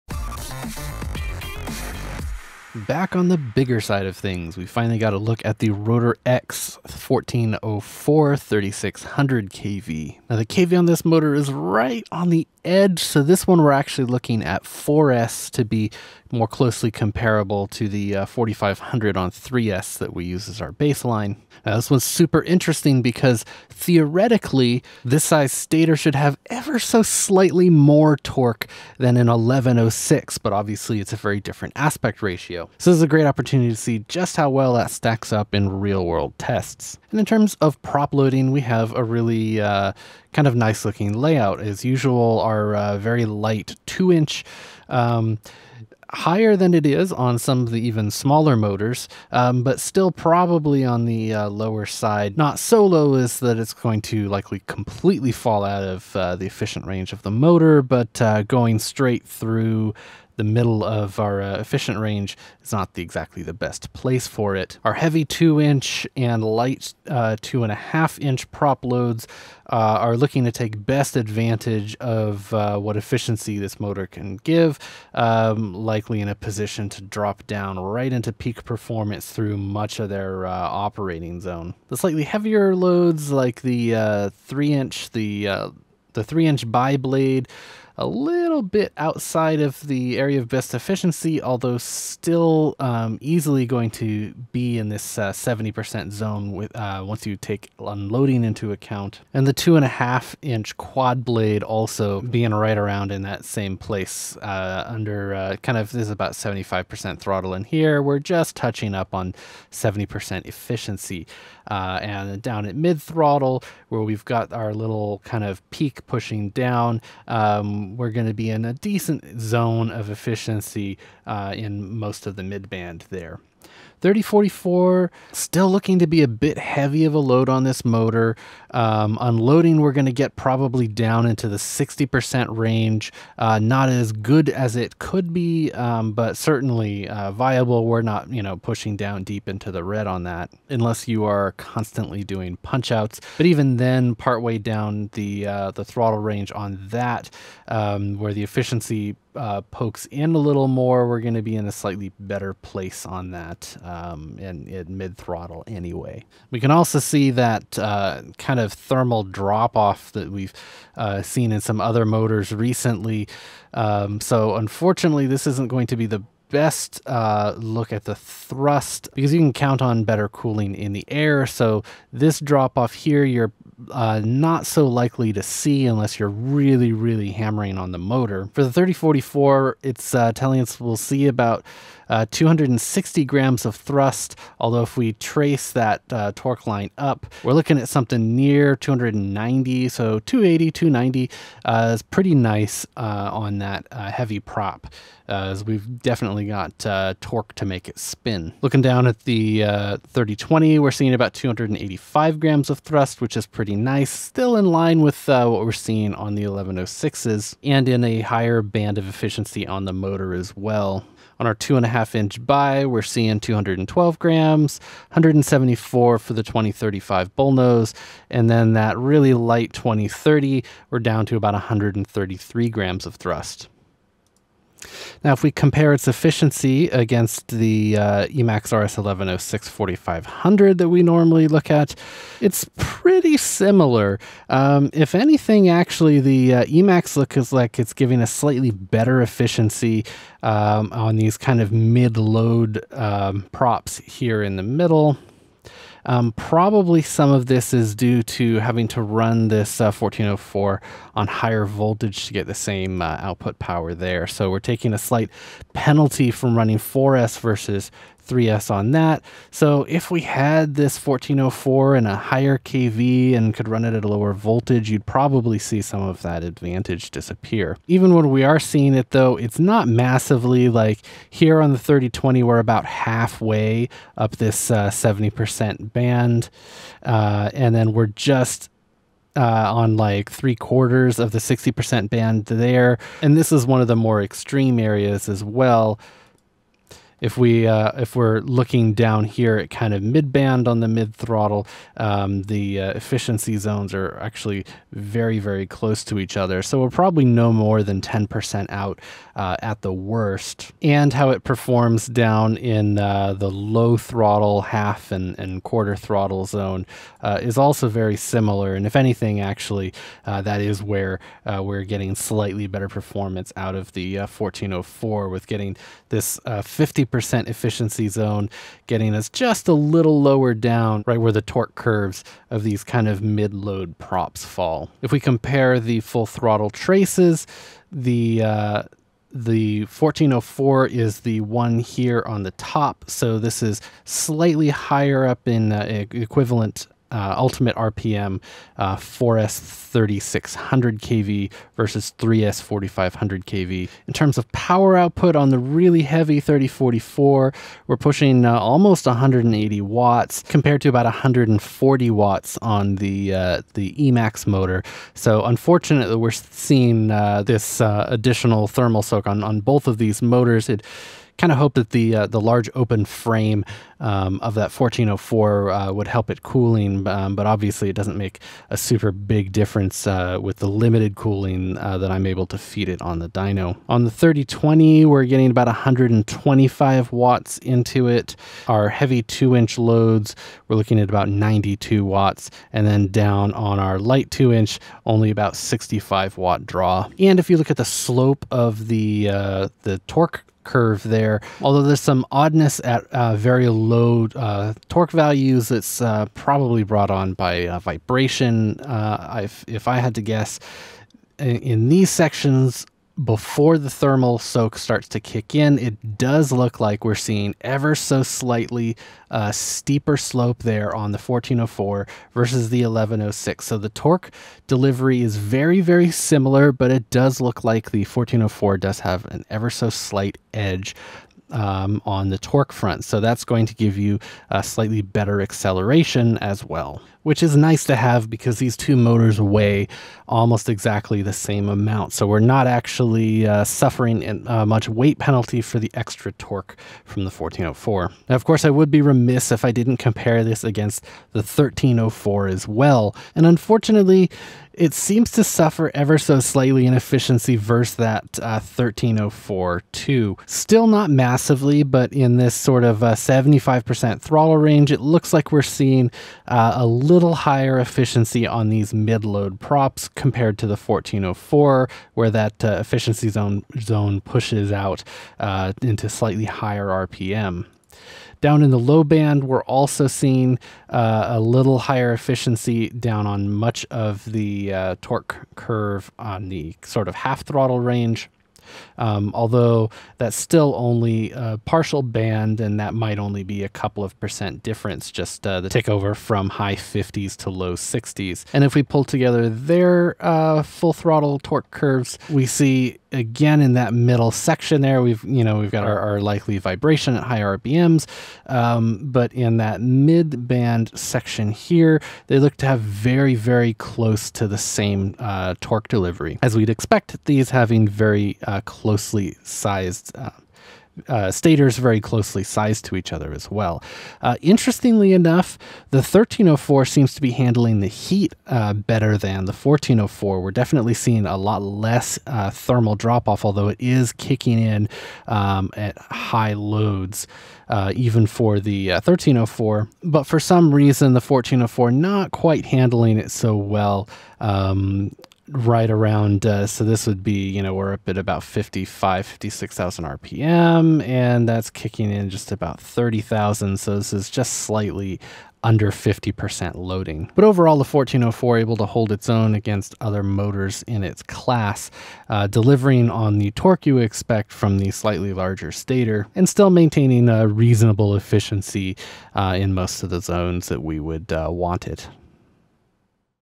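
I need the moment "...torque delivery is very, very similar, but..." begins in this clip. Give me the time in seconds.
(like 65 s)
413 s.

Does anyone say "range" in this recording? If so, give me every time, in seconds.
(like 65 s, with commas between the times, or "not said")
56 s, 61 s, 132 s, 146 s, 454 s, 477 s.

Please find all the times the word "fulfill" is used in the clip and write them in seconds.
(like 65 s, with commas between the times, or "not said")
not said.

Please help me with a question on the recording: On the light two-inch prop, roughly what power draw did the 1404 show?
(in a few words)
65 watts.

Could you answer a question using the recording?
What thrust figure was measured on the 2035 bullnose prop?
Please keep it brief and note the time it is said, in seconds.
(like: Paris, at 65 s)
174 grams, at 215 s.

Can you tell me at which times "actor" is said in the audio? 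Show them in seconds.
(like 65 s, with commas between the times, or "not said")
not said.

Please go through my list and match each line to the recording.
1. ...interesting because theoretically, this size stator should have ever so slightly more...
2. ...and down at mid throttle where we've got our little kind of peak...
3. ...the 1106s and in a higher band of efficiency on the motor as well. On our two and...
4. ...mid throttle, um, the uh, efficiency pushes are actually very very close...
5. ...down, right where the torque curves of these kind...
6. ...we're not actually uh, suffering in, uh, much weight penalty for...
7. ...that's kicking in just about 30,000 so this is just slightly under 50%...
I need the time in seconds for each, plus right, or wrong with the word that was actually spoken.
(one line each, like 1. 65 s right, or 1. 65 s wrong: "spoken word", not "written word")
1. 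22 s right
2. 112 s right
3. 206 s right
4. 290 s wrong: "zones", not "pushes"
5. 320 s right
6. 432 s right
7. 541 s right.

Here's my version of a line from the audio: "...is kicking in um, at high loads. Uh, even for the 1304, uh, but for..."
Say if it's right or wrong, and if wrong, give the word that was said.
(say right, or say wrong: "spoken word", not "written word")
right.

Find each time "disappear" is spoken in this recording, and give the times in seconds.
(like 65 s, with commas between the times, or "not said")
267 s.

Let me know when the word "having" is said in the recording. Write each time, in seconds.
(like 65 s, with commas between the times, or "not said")
248 s, 507 s.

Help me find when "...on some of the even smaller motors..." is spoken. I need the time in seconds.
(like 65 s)
47 s.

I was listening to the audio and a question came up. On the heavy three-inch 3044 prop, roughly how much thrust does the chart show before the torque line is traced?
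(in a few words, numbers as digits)
260 grams.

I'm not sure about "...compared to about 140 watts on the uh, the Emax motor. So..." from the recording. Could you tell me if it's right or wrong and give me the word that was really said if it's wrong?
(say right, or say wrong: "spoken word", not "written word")
right.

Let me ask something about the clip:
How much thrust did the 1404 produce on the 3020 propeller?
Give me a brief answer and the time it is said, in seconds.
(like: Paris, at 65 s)
285 grams, at 201 s.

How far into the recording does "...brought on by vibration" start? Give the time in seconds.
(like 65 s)
396 s.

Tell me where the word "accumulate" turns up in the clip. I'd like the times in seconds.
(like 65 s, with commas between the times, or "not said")
not said.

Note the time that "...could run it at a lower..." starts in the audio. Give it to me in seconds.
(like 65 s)
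263 s.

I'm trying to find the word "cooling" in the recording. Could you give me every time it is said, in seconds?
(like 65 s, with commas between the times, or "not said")
170 s, 366 s, 371 s.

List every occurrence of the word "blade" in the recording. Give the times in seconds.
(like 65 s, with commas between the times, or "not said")
86 s, 101 s.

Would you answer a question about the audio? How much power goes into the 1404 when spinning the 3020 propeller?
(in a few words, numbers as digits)
125 watts.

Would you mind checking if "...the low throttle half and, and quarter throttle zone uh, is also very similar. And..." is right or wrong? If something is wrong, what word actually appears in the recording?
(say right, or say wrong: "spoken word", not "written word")
right.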